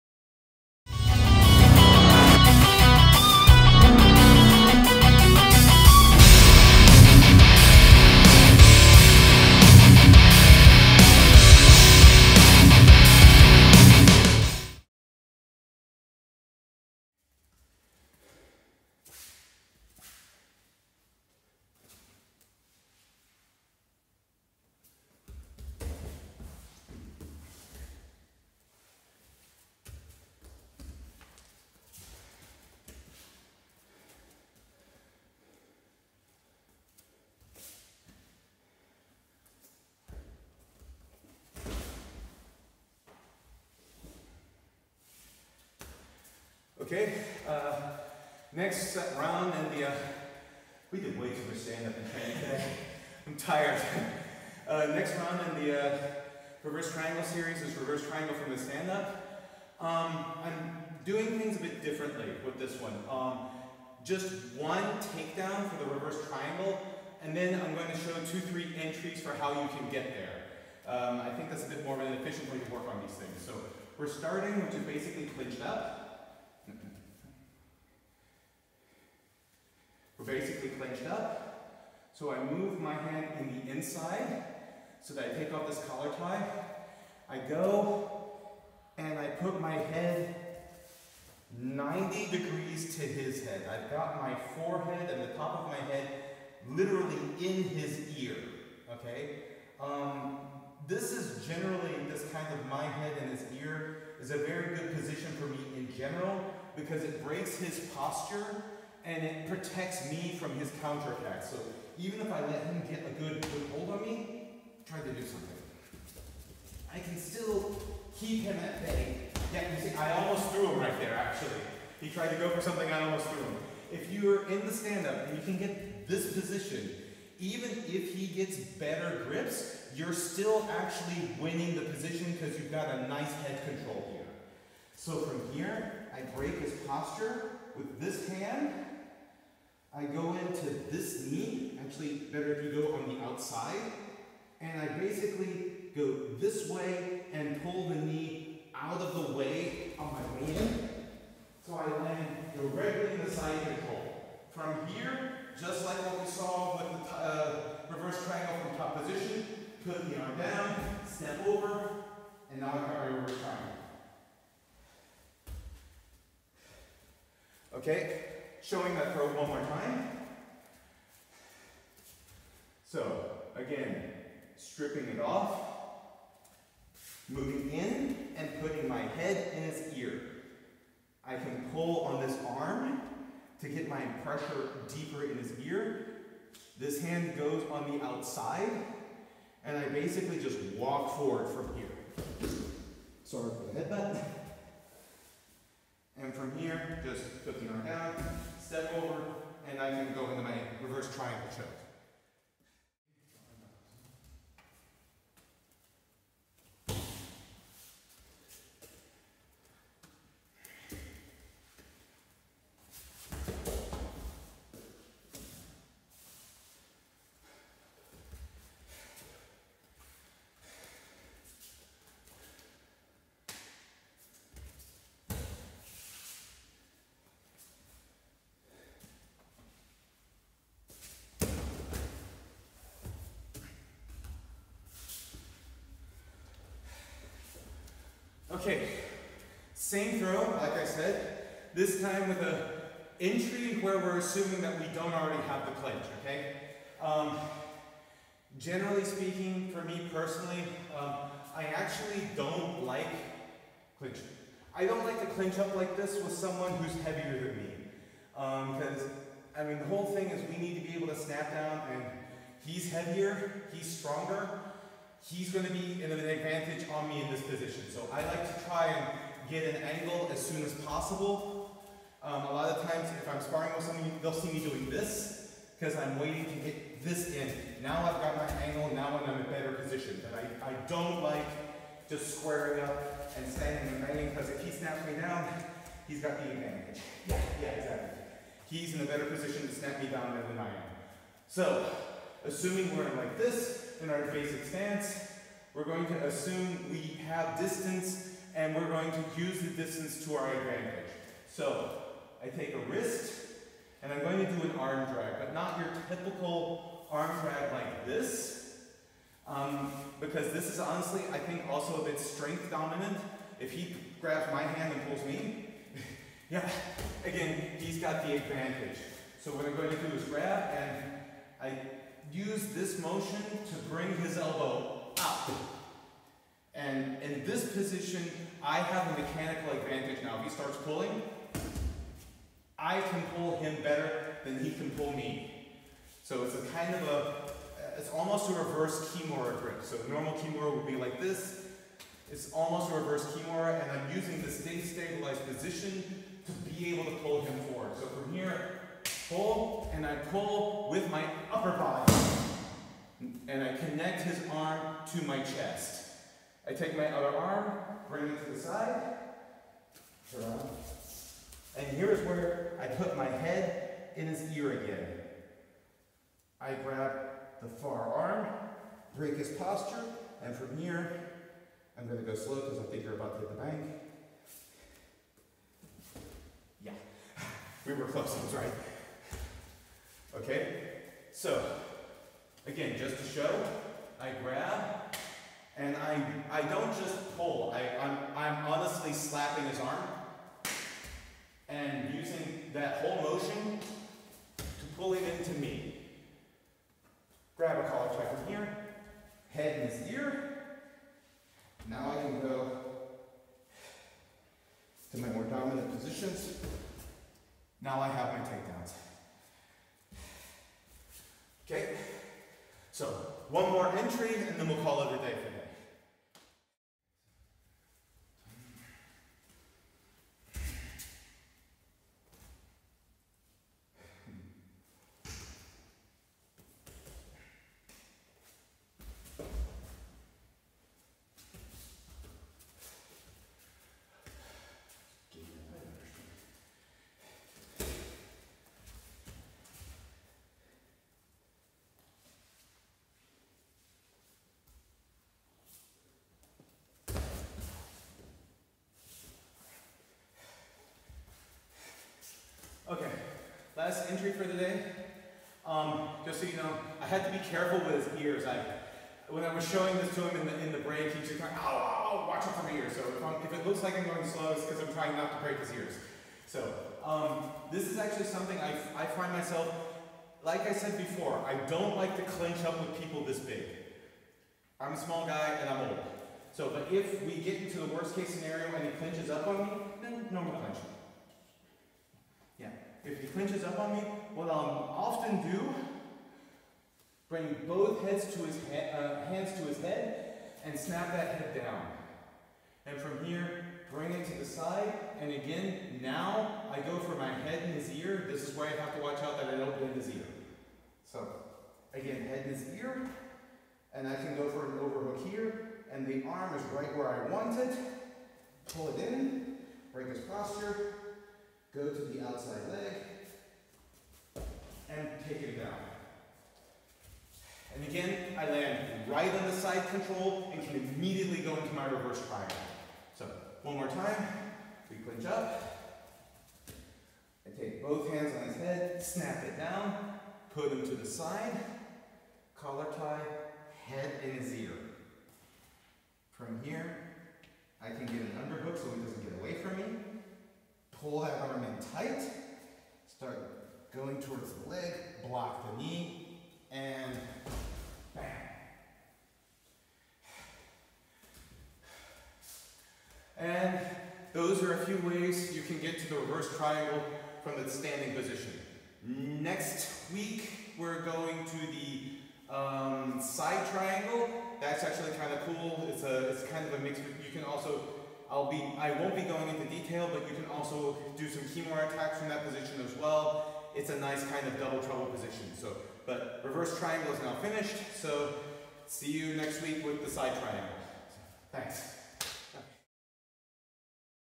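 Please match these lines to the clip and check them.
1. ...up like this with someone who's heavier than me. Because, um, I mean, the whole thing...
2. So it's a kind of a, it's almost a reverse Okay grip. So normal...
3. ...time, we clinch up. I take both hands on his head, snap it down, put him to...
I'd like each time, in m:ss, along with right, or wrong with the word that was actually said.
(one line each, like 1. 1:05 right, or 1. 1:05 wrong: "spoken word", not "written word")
1. 4:15 right
2. 5:36 wrong: "Kimura", not "Okay"
3. 8:43 right.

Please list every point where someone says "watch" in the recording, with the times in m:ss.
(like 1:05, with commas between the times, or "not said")
7:42, 8:19.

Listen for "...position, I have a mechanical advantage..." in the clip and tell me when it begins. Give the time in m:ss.
5:27.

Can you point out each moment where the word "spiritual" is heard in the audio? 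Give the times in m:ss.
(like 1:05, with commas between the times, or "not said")
not said.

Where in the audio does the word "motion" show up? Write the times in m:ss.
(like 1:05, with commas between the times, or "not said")
5:23, 6:33.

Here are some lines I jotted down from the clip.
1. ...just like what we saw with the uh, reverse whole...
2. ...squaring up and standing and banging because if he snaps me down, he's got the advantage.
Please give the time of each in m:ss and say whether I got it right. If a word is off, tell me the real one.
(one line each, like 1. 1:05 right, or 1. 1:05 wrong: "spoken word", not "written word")
1. 2:35 wrong: "triangle", not "whole"
2. 4:42 right.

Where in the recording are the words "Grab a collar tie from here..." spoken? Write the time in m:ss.
6:37.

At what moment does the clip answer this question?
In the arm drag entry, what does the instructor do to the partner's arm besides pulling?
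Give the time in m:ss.
6:29.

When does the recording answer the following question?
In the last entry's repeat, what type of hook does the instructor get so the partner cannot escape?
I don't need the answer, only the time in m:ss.
8:58.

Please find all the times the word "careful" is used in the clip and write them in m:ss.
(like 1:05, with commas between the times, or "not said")
7:37.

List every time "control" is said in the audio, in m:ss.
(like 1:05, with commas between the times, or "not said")
2:13, 2:33, 8:39.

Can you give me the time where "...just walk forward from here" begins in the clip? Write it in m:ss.
3:10.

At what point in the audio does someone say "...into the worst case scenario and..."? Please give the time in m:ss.
7:57.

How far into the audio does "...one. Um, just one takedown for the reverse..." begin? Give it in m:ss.
1:02.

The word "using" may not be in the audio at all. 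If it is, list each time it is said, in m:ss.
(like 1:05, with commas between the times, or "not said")
5:44, 6:32.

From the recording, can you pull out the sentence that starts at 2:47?
Okay, Showing that throw one more time.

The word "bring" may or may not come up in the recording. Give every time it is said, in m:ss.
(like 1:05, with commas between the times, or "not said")
5:23, 5:58, 8:07, 8:13.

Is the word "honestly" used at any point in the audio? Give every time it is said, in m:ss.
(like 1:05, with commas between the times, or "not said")
5:10, 6:28.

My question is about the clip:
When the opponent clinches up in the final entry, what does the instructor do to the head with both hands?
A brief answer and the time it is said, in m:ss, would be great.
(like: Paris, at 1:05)
Snap it down, at 8:10.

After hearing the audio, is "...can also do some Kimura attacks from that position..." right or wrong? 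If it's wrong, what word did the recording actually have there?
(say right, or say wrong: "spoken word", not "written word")
right.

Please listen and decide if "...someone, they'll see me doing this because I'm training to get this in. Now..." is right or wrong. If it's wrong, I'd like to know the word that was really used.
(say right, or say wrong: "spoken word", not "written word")
wrong: "waiting", not "training".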